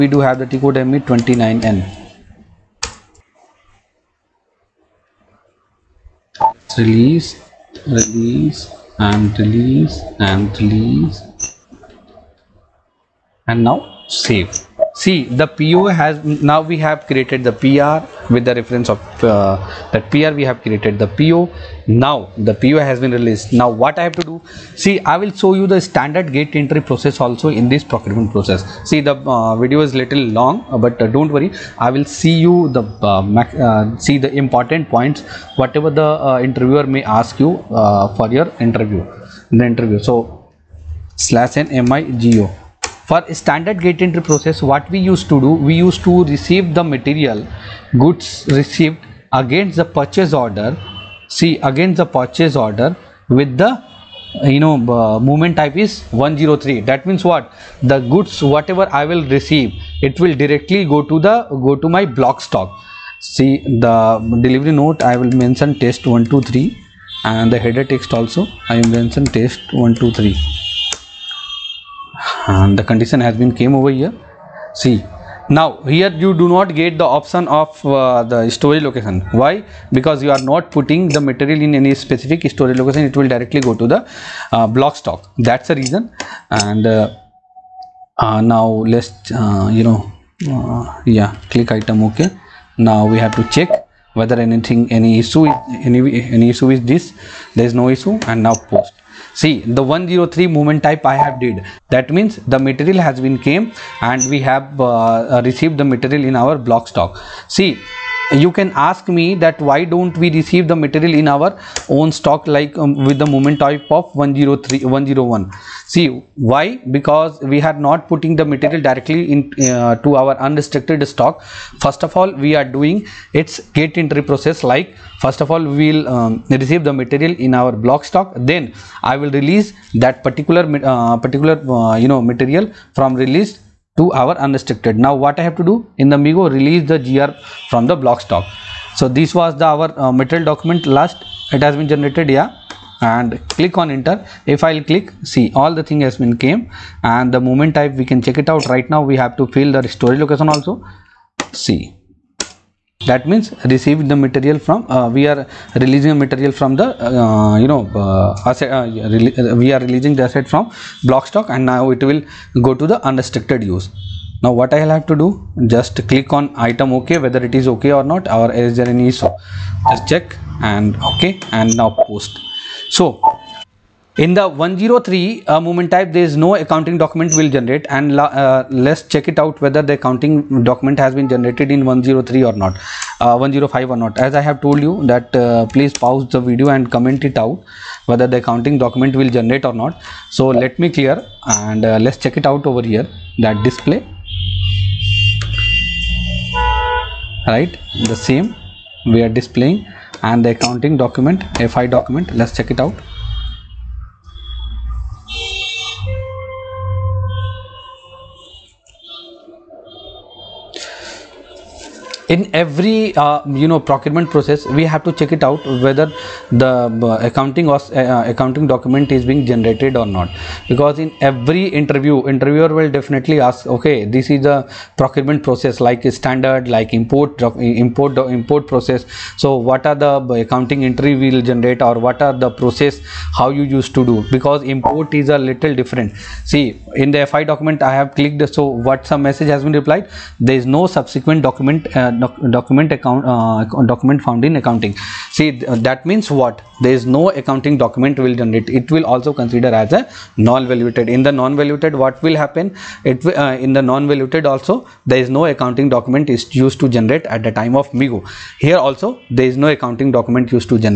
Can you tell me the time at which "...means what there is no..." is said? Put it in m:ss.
4:06.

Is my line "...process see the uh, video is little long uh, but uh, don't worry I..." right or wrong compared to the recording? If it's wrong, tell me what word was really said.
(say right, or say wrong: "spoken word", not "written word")
right.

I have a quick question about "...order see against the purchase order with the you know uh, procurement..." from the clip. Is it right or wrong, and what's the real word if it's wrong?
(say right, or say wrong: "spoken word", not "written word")
wrong: "movement", not "procurement".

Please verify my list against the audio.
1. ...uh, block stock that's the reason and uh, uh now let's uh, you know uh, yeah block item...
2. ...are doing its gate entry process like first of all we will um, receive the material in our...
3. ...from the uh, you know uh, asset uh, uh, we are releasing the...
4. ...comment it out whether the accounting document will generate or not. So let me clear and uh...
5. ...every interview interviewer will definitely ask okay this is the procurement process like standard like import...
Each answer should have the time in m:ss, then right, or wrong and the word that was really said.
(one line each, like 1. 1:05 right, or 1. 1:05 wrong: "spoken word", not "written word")
1. 1:24 wrong: "click", not "block"
2. 2:02 right
3. 2:36 right
4. 3:06 right
5. 3:41 right.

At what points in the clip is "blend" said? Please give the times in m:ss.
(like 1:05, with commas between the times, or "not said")
not said.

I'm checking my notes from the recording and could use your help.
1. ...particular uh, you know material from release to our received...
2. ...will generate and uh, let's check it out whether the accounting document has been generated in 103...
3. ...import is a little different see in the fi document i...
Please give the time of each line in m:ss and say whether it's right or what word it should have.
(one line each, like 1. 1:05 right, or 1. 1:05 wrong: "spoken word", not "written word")
1. 2:11 wrong: "unrestricted", not "received"
2. 2:57 right
3. 3:54 right.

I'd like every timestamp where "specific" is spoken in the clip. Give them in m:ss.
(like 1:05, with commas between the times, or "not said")
1:21.